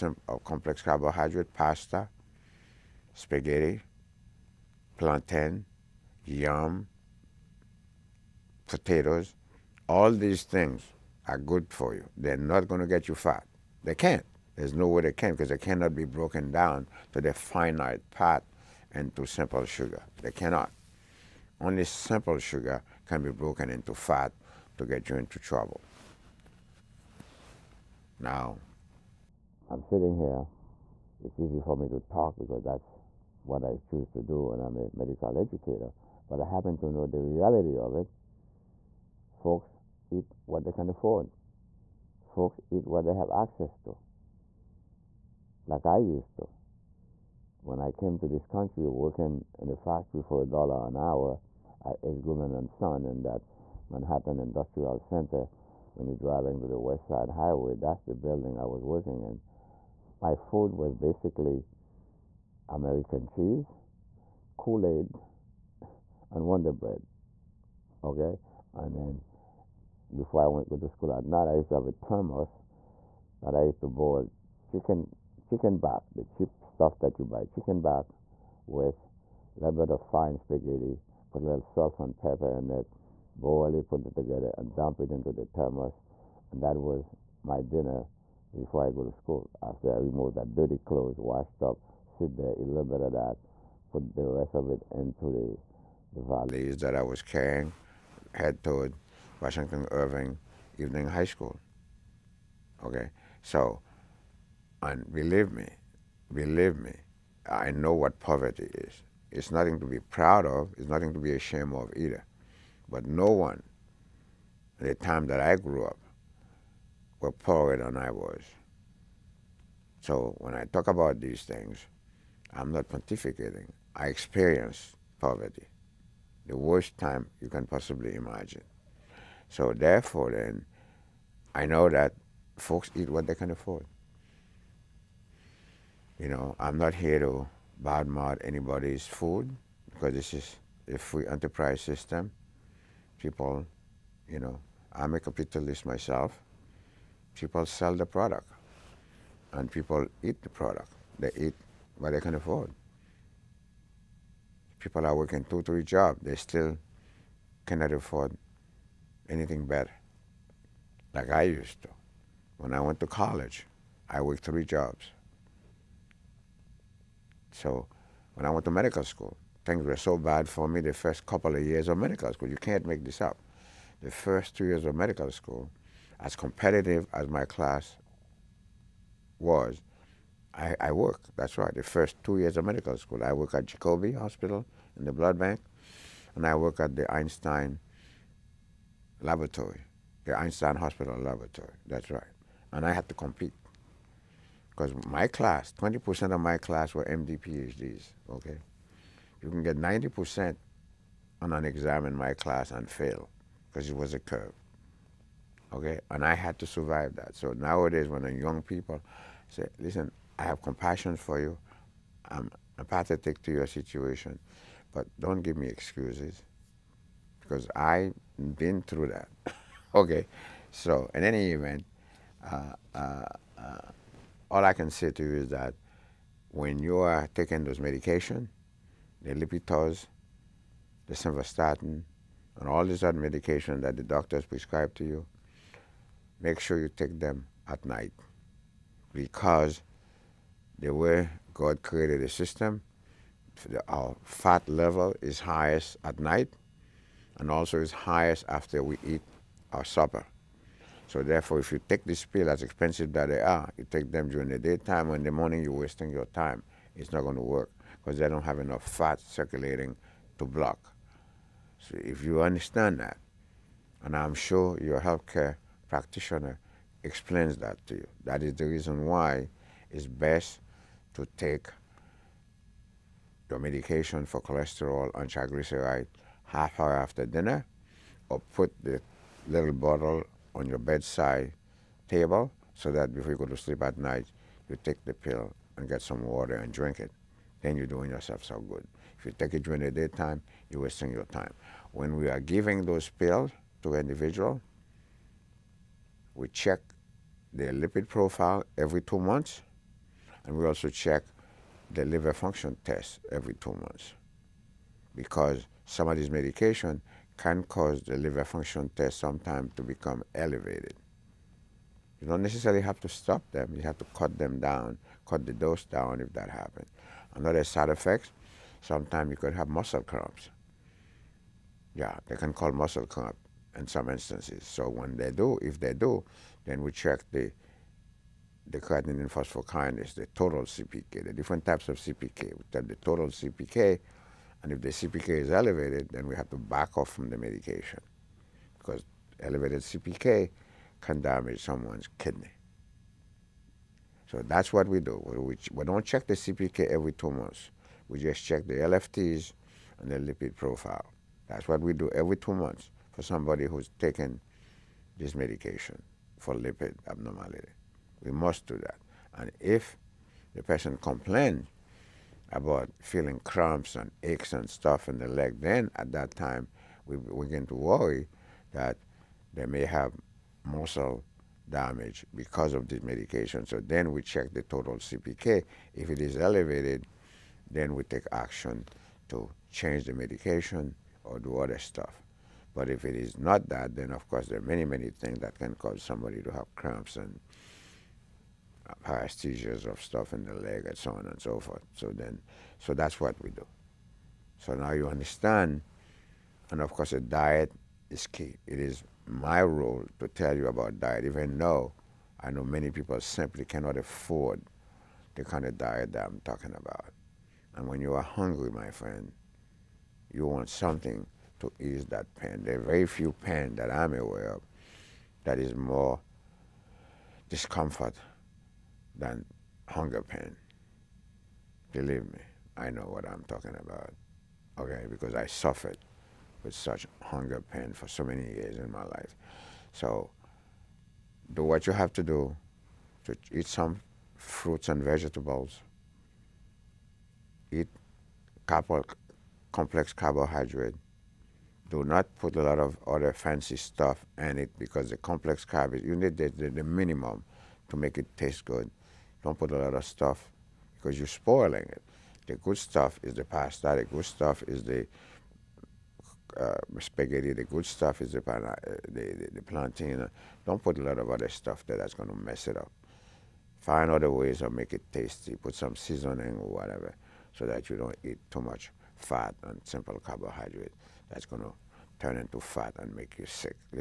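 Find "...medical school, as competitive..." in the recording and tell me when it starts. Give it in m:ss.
2:54.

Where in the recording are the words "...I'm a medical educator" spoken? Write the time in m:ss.
0:34.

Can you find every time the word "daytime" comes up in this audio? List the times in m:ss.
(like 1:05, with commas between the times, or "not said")
4:14, 4:49.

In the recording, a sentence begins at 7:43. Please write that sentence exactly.
Find other ways of make it tasty.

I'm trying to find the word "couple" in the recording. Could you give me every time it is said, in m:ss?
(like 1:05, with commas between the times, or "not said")
2:51, 7:18.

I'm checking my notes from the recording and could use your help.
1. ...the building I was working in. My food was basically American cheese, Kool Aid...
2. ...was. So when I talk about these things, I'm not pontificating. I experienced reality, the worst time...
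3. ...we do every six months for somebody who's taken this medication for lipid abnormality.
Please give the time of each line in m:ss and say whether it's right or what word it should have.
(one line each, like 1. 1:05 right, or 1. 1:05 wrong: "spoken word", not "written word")
1. 0:58 right
2. 1:58 wrong: "poverty", not "reality"
3. 5:51 wrong: "two", not "six".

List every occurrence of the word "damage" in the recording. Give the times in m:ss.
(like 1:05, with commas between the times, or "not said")
5:41, 6:11.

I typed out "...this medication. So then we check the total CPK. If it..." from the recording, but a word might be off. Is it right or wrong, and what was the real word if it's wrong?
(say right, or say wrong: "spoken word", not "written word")
right.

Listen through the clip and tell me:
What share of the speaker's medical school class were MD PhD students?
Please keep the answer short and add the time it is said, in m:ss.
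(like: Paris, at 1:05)
20%, at 3:15.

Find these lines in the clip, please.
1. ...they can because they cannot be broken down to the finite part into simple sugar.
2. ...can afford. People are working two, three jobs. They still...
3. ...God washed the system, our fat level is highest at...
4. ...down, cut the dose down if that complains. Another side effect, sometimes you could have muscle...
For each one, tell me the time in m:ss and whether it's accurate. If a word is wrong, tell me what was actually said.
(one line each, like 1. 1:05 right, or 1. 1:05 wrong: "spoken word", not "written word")
1. 0:15 right
2. 2:32 right
3. 4:01 wrong: "created", not "washed"
4. 5:14 wrong: "happens", not "complains".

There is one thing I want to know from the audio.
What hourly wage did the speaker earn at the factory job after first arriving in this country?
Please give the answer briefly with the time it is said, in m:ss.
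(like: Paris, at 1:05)
$1 an hour, at 0:50.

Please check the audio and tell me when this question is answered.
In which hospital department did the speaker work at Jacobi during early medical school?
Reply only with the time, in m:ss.
3:05.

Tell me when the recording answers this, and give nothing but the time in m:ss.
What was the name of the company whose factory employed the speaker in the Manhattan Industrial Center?
0:52.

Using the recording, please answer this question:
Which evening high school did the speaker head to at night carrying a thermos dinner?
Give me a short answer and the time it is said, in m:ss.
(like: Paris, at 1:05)
Washington Irving Evening High School, at 1:39.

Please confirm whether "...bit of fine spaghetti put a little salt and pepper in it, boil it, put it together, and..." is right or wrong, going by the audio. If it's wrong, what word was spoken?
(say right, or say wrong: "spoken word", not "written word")
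right.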